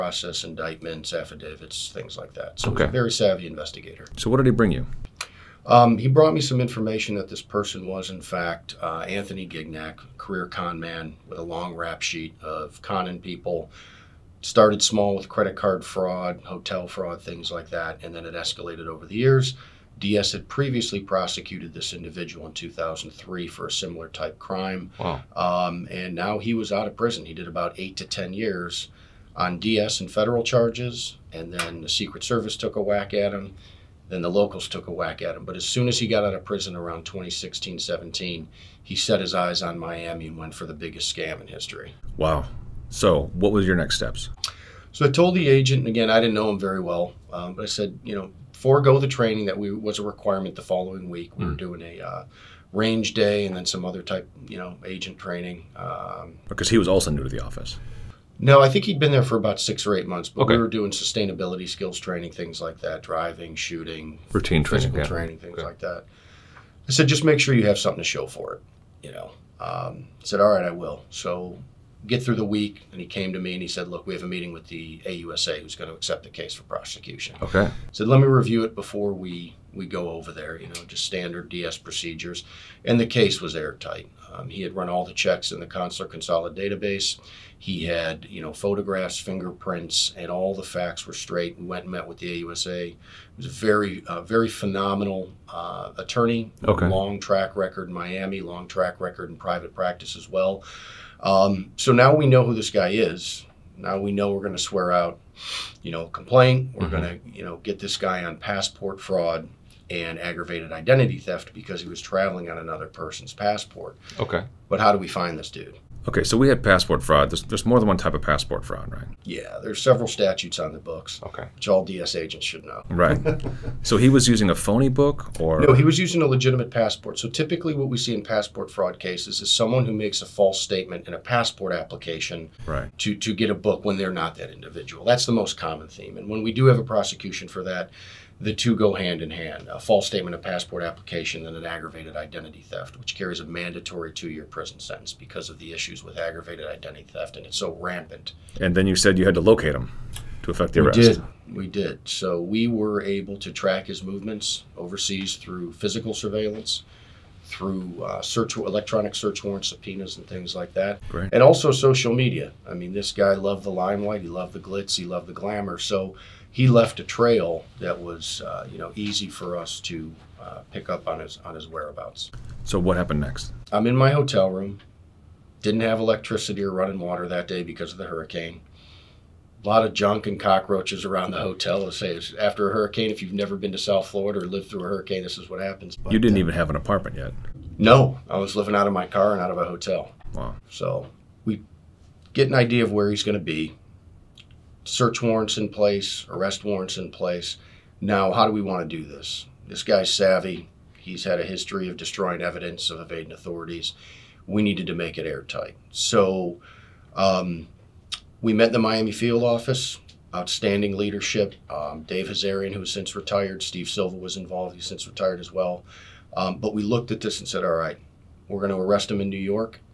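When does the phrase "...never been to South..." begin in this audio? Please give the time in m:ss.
3:03.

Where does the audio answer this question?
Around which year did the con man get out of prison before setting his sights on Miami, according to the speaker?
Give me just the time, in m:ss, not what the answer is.
0:37.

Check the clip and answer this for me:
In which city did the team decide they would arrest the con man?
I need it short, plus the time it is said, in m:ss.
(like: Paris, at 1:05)
New York, at 3:39.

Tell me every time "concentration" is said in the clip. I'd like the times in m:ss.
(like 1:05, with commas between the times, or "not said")
not said.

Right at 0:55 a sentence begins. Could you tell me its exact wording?
Um, because he was also new to the office.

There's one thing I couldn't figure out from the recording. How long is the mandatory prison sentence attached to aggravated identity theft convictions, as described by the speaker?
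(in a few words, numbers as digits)
2 years.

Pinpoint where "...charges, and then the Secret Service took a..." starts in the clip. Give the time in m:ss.
0:30.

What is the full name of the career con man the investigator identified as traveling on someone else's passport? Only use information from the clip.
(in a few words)
Anthony Gignac.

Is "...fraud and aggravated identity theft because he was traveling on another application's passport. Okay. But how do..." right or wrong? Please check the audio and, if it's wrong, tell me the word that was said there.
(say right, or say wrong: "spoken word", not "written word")
wrong: "person", not "application".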